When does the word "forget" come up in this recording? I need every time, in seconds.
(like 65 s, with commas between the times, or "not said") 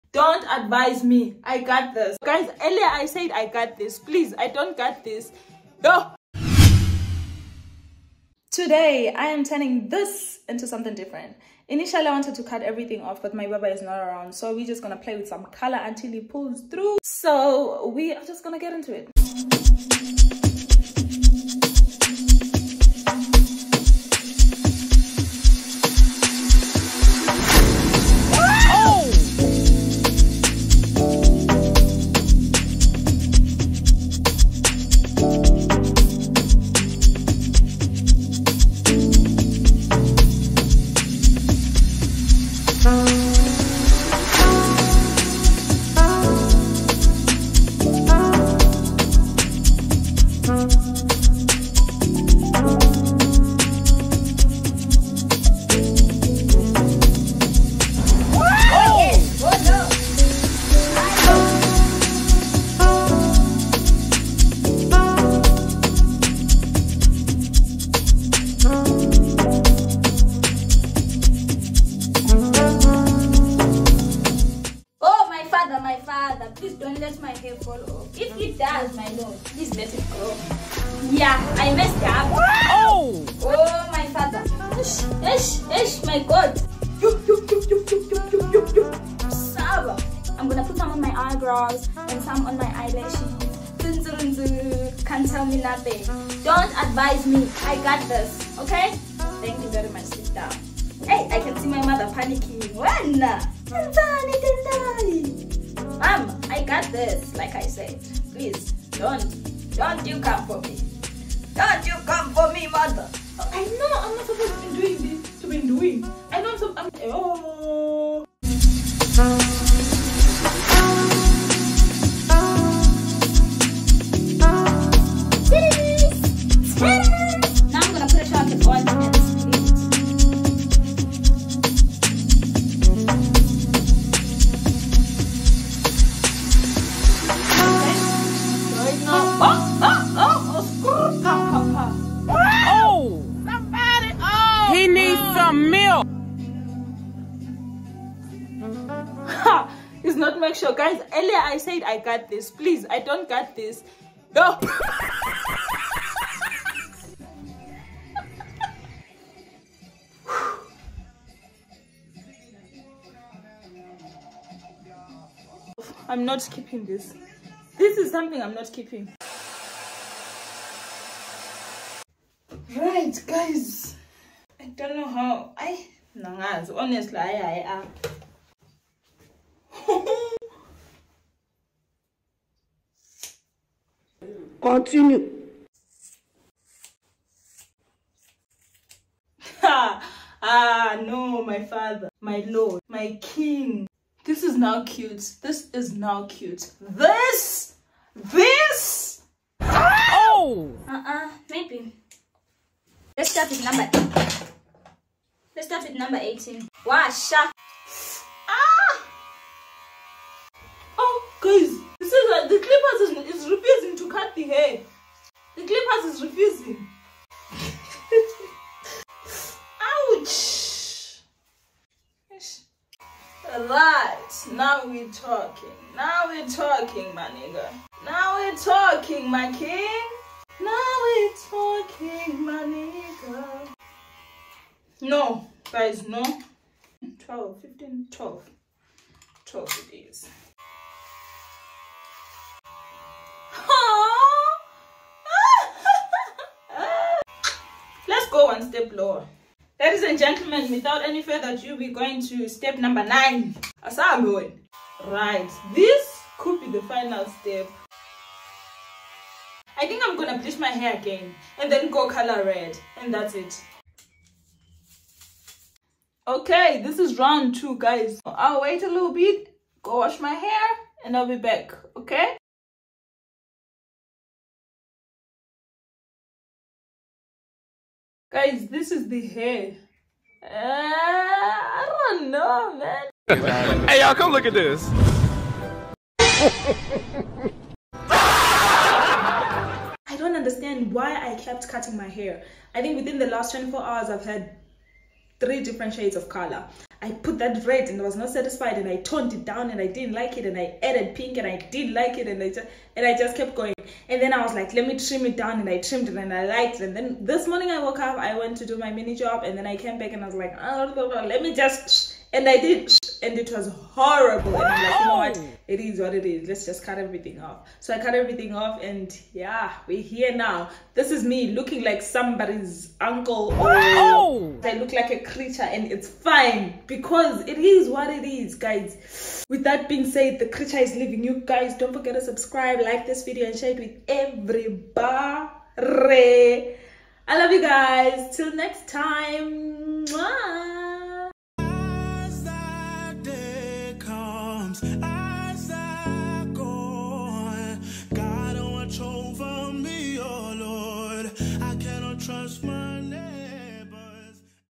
331 s.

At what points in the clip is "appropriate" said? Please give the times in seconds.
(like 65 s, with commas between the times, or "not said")
not said.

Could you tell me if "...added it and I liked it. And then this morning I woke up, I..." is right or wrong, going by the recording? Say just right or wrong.
wrong.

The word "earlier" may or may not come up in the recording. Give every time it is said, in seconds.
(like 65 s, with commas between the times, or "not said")
2 s, 151 s.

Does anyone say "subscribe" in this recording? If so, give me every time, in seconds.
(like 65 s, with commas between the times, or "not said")
332 s.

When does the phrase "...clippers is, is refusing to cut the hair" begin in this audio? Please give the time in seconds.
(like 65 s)
212 s.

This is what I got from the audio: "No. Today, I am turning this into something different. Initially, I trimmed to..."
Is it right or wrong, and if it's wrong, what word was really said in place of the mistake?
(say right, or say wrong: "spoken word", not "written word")
wrong: "wanted", not "trimmed".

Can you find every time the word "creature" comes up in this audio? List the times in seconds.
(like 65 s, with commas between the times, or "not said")
325 s, 330 s.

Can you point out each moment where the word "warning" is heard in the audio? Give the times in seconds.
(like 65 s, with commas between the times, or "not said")
not said.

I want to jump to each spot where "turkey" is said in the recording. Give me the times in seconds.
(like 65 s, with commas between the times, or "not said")
not said.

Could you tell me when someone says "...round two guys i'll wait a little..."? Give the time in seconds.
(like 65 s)
267 s.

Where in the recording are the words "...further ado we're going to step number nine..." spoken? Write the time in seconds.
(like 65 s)
251 s.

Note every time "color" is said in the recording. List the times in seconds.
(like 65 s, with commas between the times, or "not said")
15 s, 262 s, 296 s.